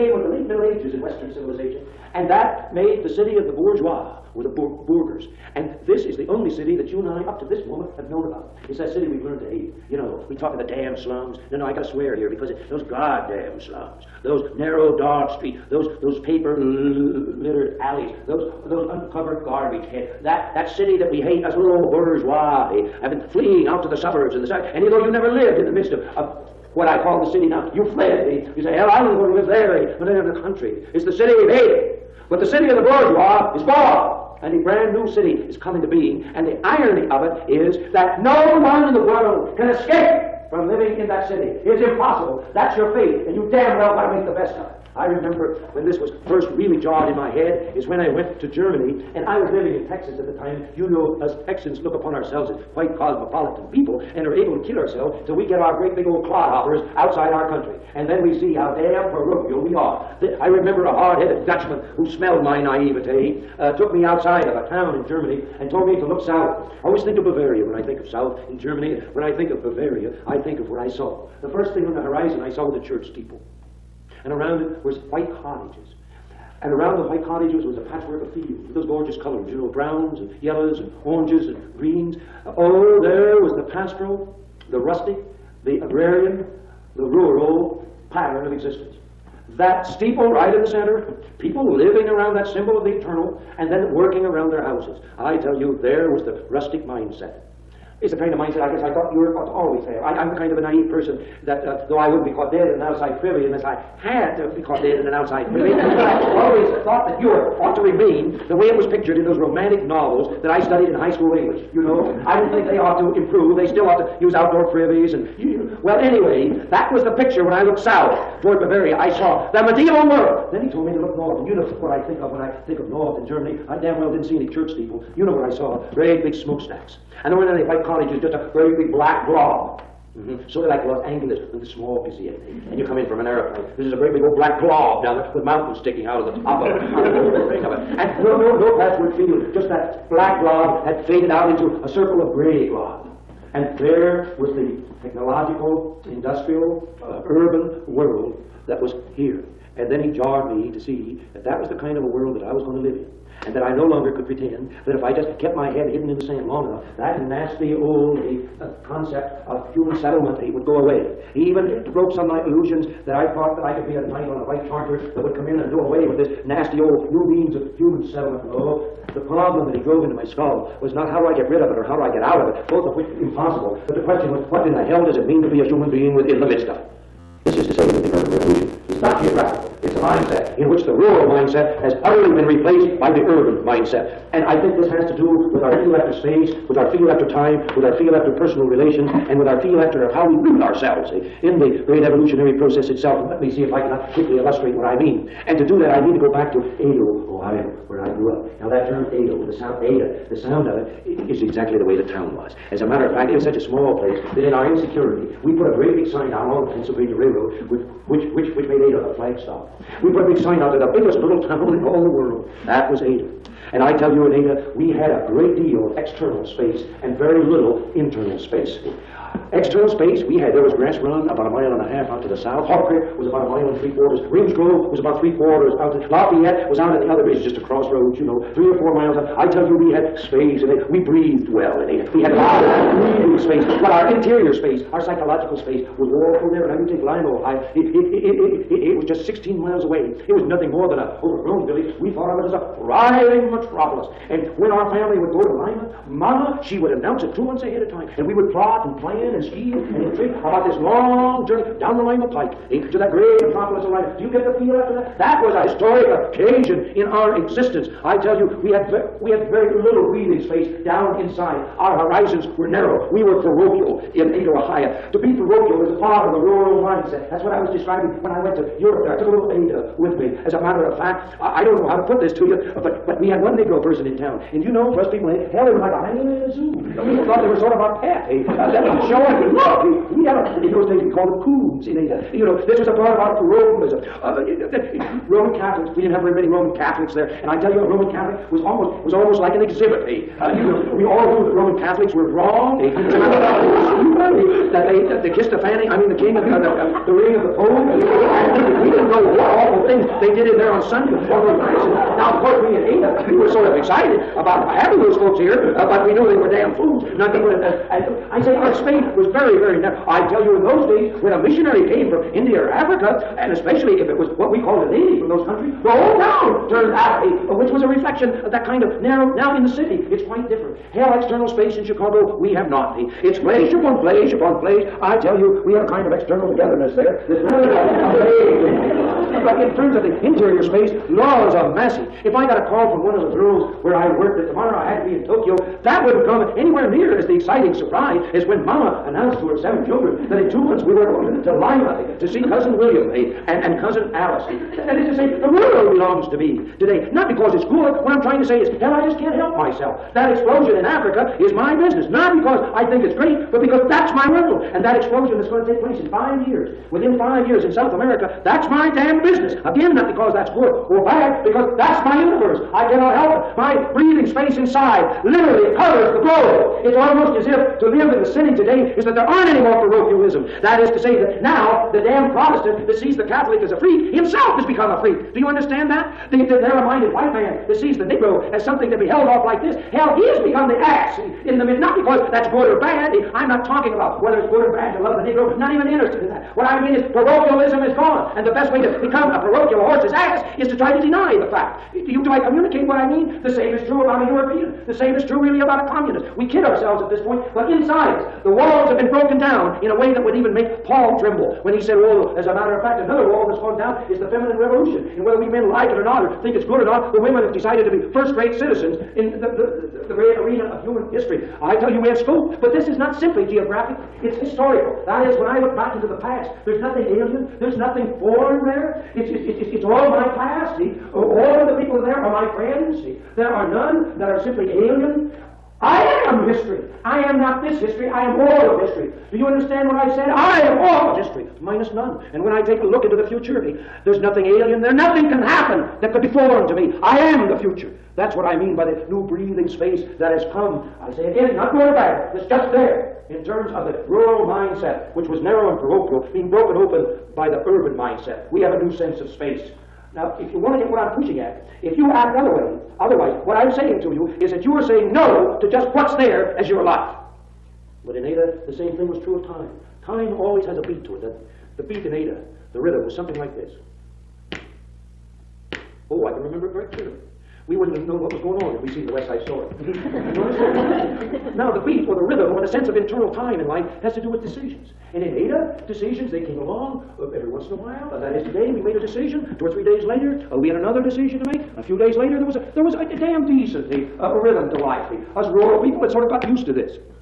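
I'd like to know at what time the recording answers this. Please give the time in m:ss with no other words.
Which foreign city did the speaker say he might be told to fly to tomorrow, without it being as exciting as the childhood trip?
5:35.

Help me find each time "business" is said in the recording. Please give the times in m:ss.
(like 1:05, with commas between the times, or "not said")
5:51, 5:59.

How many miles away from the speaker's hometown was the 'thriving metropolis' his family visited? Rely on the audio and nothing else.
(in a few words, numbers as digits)
16.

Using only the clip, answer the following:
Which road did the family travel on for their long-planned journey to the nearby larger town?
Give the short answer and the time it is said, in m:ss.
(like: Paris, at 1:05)
Lima Pike, at 4:12.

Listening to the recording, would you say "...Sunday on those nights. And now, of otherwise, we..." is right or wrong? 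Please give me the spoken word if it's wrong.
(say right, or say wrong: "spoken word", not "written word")
wrong: "course", not "otherwise".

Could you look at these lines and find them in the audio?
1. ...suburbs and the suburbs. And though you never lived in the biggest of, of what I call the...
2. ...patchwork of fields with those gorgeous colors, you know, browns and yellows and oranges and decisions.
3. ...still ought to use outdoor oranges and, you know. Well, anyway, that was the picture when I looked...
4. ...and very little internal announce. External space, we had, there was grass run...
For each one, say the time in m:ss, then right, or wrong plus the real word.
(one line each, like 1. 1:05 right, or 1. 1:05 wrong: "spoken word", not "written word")
1. 0:23 wrong: "midst", not "biggest"
2. 1:17 wrong: "greens", not "decisions"
3. 1:53 wrong: "privies", not "oranges"
4. 3:37 wrong: "space", not "announce".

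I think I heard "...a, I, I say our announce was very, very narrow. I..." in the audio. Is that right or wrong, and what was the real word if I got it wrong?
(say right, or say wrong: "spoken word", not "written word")
wrong: "space", not "announce".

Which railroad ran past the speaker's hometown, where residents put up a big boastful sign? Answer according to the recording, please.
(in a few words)
Pennsylvania Railroad.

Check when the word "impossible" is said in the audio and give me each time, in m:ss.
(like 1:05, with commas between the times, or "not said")
0:41, 2:53.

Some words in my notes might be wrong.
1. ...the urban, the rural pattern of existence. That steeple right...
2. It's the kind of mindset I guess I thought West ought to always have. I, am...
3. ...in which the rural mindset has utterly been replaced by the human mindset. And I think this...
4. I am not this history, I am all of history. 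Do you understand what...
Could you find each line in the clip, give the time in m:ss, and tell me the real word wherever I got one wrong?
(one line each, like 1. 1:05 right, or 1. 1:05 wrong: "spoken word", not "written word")
1. 1:25 wrong: "agrarian", not "urban"
2. 1:38 wrong: "Europe", not "West"
3. 3:00 wrong: "urban", not "human"
4. 7:07 right.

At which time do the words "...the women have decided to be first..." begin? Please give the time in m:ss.
6:47.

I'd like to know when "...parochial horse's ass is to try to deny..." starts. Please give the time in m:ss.
6:29.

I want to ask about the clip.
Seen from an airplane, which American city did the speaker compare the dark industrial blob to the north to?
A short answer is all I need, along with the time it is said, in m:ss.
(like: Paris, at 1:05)
Los Angeles, at 2:10.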